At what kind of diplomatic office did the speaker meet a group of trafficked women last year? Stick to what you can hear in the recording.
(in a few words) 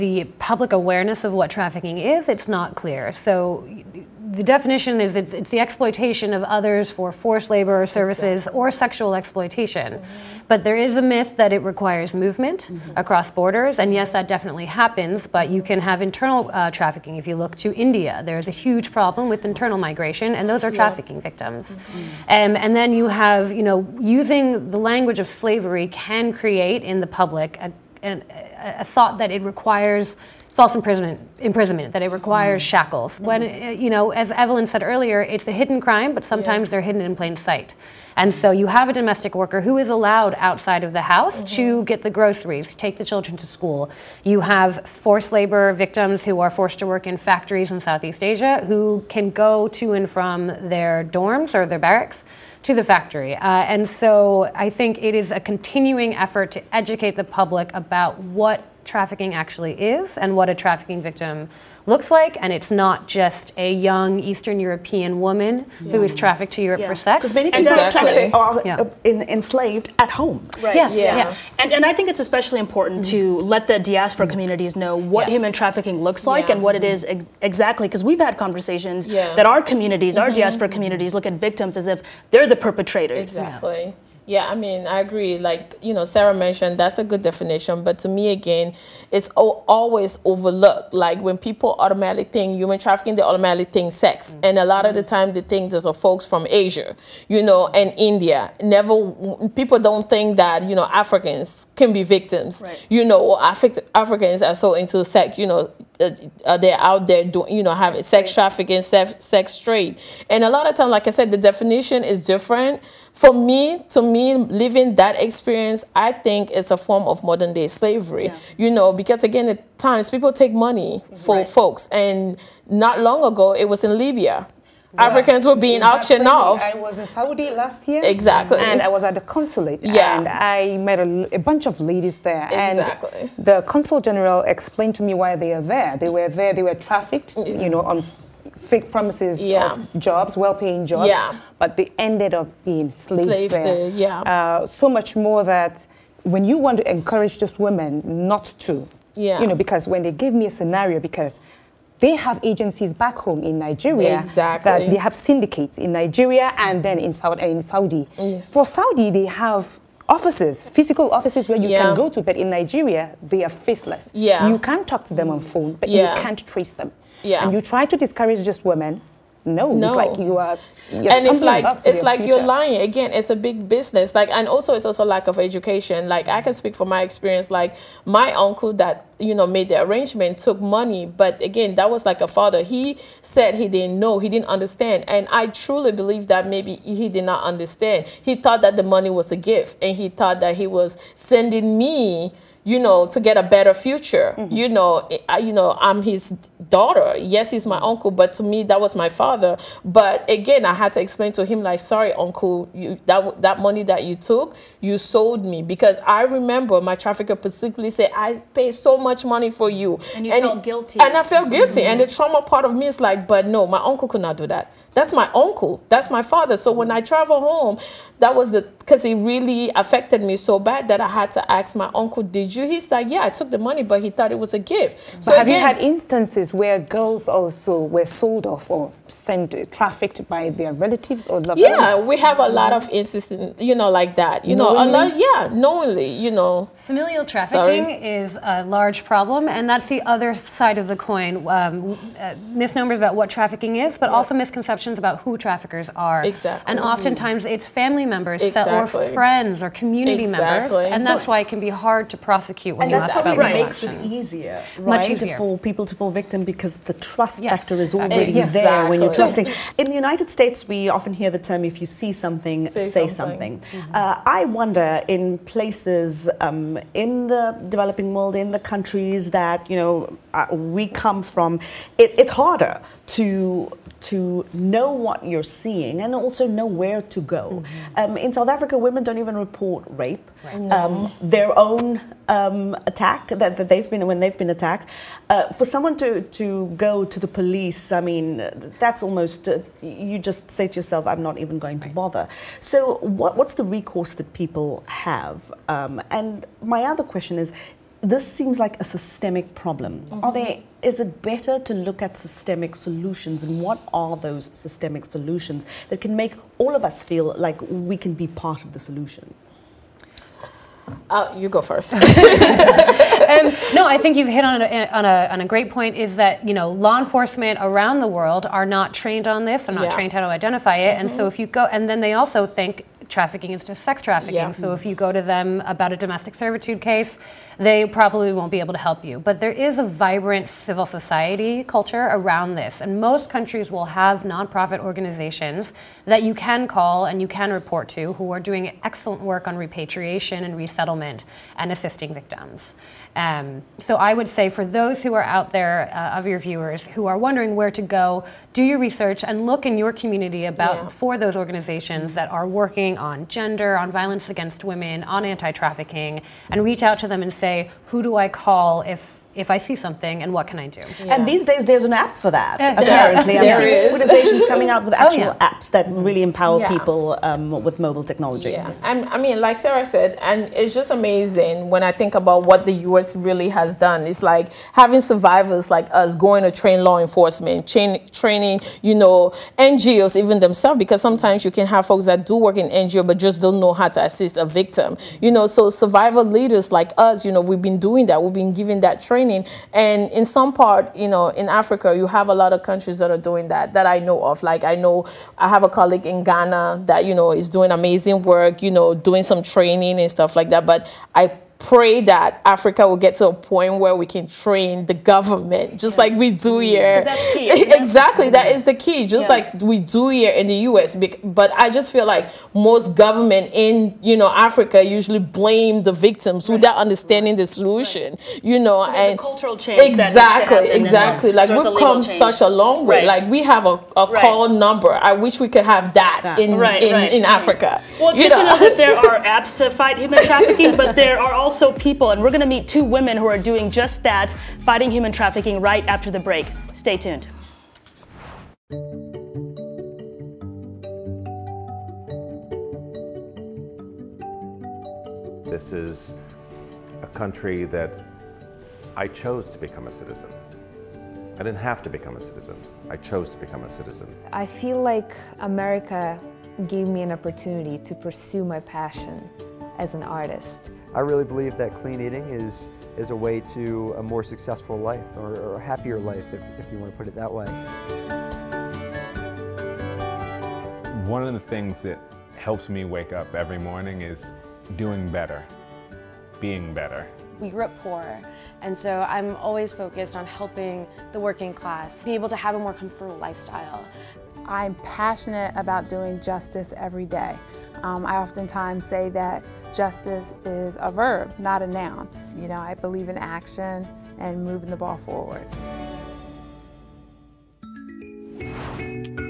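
The consulate.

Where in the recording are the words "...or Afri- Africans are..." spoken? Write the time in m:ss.
1:43.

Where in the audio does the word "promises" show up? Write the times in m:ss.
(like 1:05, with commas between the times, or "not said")
2:18.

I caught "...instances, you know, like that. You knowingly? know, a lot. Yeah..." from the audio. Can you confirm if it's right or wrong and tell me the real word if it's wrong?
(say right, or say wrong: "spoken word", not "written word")
right.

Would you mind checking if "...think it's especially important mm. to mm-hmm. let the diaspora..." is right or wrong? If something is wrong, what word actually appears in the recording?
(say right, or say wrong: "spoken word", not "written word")
right.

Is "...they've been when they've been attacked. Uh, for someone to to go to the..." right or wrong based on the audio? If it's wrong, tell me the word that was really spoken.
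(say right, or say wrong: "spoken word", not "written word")
right.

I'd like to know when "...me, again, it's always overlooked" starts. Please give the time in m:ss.
1:28.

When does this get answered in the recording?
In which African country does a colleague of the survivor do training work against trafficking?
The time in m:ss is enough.
6:36.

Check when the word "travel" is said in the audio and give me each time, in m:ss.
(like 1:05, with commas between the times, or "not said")
3:36.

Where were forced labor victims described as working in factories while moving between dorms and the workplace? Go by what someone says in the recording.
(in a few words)
Southeast Asia.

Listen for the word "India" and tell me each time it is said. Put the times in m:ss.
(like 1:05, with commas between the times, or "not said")
0:17, 1:37.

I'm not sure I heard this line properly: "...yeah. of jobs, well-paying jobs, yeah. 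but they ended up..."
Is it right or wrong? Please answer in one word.
right.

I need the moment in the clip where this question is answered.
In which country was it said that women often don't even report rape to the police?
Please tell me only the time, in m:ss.
4:38.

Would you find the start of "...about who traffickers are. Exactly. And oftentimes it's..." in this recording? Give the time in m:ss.
4:04.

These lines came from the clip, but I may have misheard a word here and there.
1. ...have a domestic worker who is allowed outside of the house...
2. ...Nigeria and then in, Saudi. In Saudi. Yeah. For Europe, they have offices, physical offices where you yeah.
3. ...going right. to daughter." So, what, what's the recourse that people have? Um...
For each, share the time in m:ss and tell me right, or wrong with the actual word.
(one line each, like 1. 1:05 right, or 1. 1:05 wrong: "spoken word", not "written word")
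1. 0:38 right
2. 2:35 wrong: "Saudi", not "Europe"
3. 4:51 wrong: "bother", not "daughter".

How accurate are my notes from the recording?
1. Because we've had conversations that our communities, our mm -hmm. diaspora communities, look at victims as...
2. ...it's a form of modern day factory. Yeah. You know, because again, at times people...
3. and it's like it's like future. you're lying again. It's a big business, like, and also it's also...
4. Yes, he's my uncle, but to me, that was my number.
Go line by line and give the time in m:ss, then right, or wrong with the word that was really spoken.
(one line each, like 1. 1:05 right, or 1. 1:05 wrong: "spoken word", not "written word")
1. 1:17 right
2. 1:56 wrong: "slavery", not "factory"
3. 2:50 right
4. 3:17 wrong: "father", not "number".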